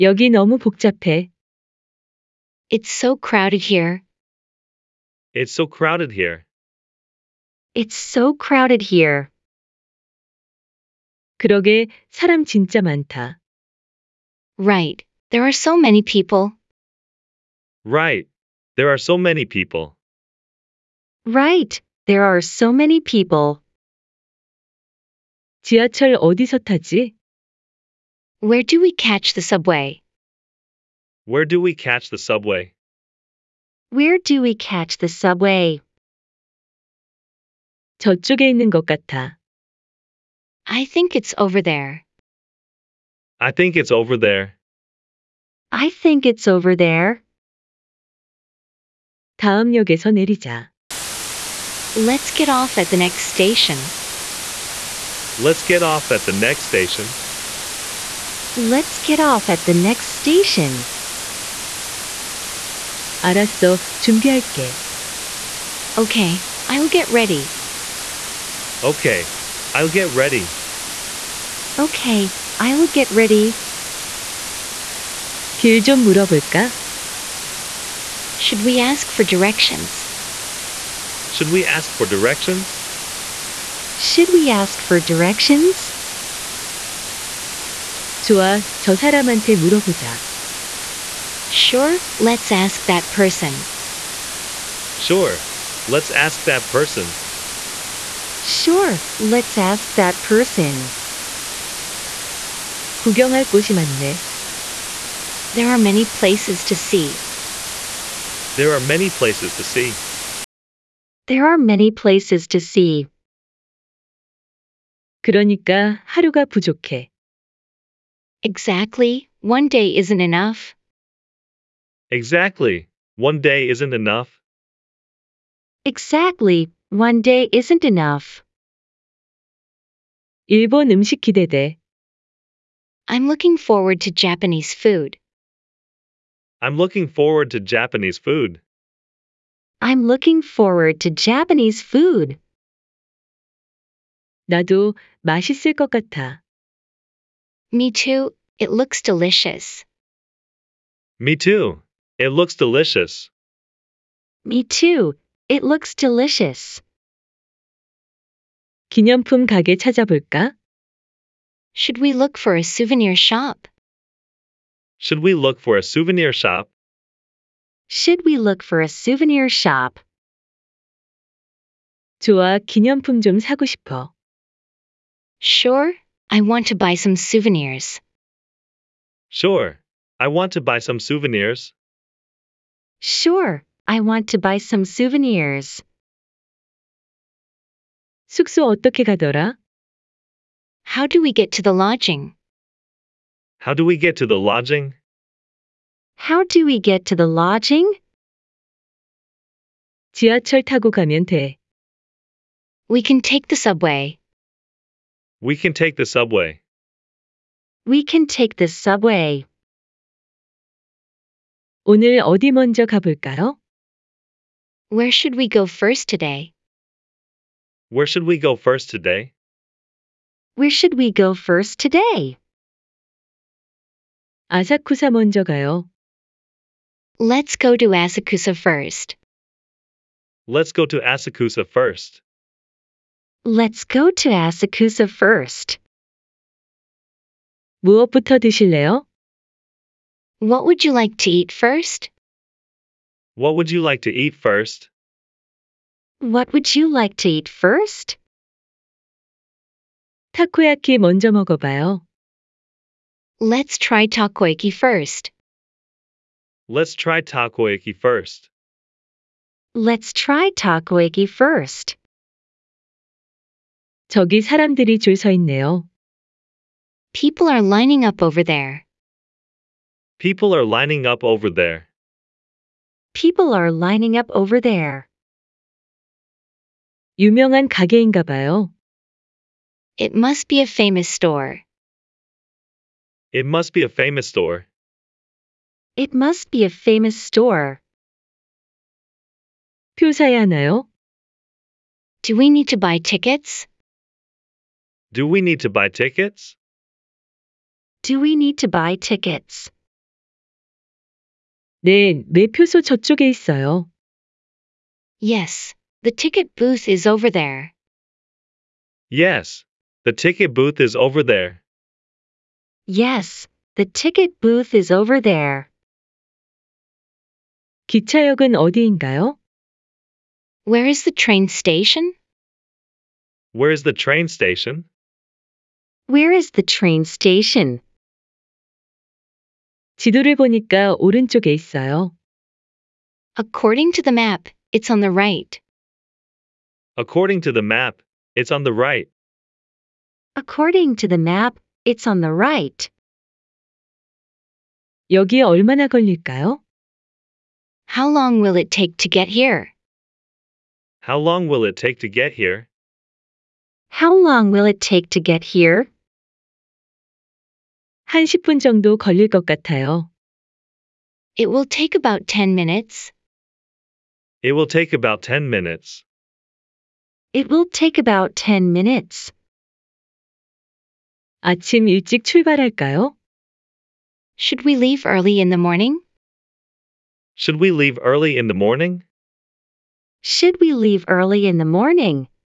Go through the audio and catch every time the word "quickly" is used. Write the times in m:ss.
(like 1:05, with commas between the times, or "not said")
not said.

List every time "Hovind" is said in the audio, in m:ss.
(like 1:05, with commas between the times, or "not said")
not said.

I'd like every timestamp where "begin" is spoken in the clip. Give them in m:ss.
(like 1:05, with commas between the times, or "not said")
not said.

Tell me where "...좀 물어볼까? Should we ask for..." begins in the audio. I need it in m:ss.
1:15.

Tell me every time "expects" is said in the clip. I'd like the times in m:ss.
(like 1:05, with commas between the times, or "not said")
not said.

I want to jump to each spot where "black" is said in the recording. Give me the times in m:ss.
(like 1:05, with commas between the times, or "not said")
not said.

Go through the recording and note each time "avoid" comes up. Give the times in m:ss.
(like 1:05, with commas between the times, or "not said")
not said.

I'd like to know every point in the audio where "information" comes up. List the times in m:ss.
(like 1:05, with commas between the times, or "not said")
not said.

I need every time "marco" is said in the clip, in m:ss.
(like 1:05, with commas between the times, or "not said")
not said.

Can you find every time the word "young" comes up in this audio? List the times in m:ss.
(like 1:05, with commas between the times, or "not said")
not said.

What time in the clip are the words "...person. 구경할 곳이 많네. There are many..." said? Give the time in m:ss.
1:40.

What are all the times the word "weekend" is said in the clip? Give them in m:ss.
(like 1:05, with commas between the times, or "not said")
not said.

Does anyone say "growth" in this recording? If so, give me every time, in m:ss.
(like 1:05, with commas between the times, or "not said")
not said.